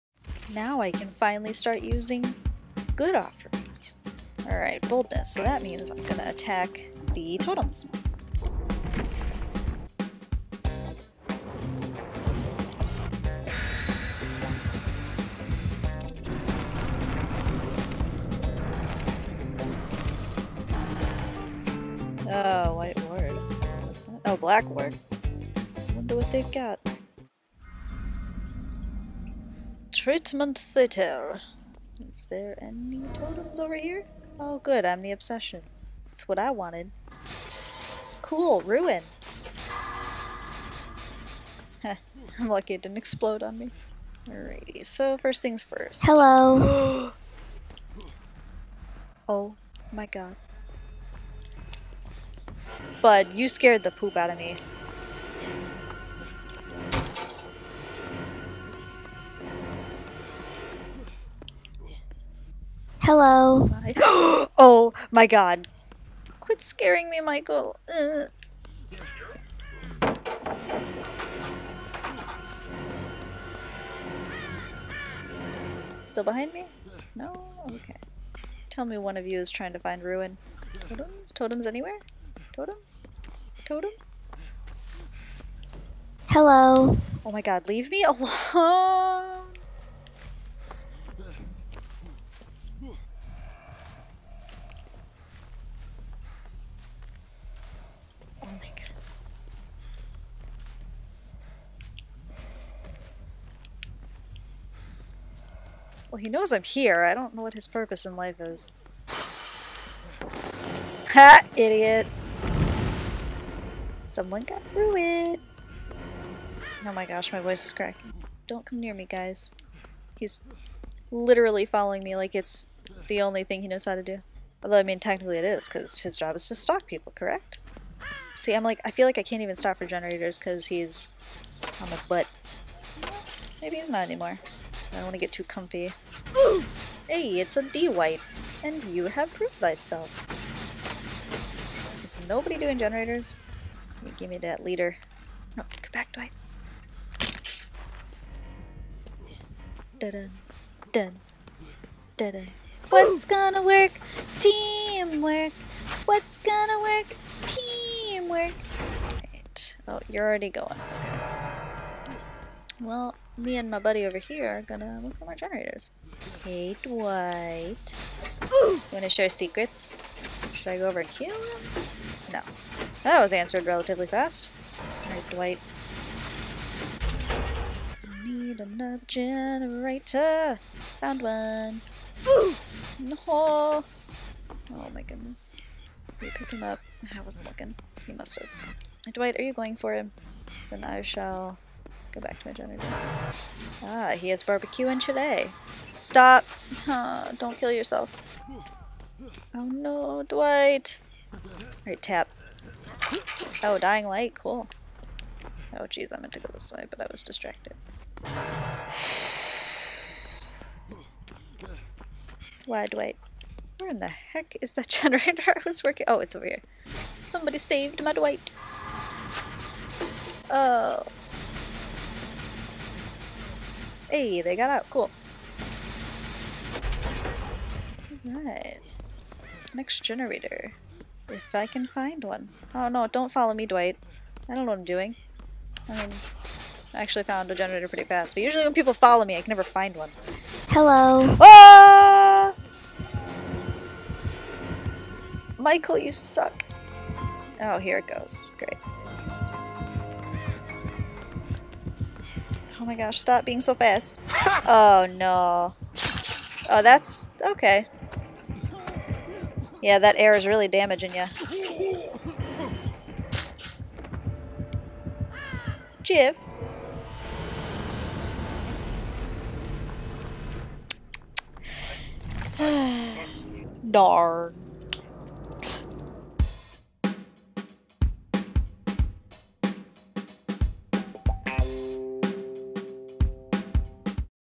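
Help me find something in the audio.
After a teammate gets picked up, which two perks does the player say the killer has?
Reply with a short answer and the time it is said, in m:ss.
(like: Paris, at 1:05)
Barbecue and chili, at 3:14.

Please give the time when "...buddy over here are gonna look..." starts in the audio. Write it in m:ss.
2:43.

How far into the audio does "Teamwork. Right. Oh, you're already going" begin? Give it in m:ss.
2:37.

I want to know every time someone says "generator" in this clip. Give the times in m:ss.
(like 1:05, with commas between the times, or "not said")
2:09, 2:22, 2:45, 2:59, 3:12, 3:34, 3:50, 3:57.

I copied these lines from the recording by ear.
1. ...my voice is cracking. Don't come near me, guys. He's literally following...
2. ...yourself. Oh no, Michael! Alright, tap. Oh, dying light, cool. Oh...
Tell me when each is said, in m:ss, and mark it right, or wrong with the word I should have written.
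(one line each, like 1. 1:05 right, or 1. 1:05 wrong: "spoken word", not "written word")
1. 1:57 right
2. 3:17 wrong: "Dwight", not "Michael".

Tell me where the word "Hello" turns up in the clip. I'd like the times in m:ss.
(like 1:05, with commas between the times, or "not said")
0:46, 1:03, 1:26, 4:00.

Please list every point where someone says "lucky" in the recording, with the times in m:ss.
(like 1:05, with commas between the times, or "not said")
0:42.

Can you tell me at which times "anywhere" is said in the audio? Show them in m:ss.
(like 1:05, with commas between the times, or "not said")
1:21.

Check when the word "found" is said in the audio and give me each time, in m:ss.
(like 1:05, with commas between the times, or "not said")
3:01, 3:57.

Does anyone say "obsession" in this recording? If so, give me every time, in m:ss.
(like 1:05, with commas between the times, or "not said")
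0:35.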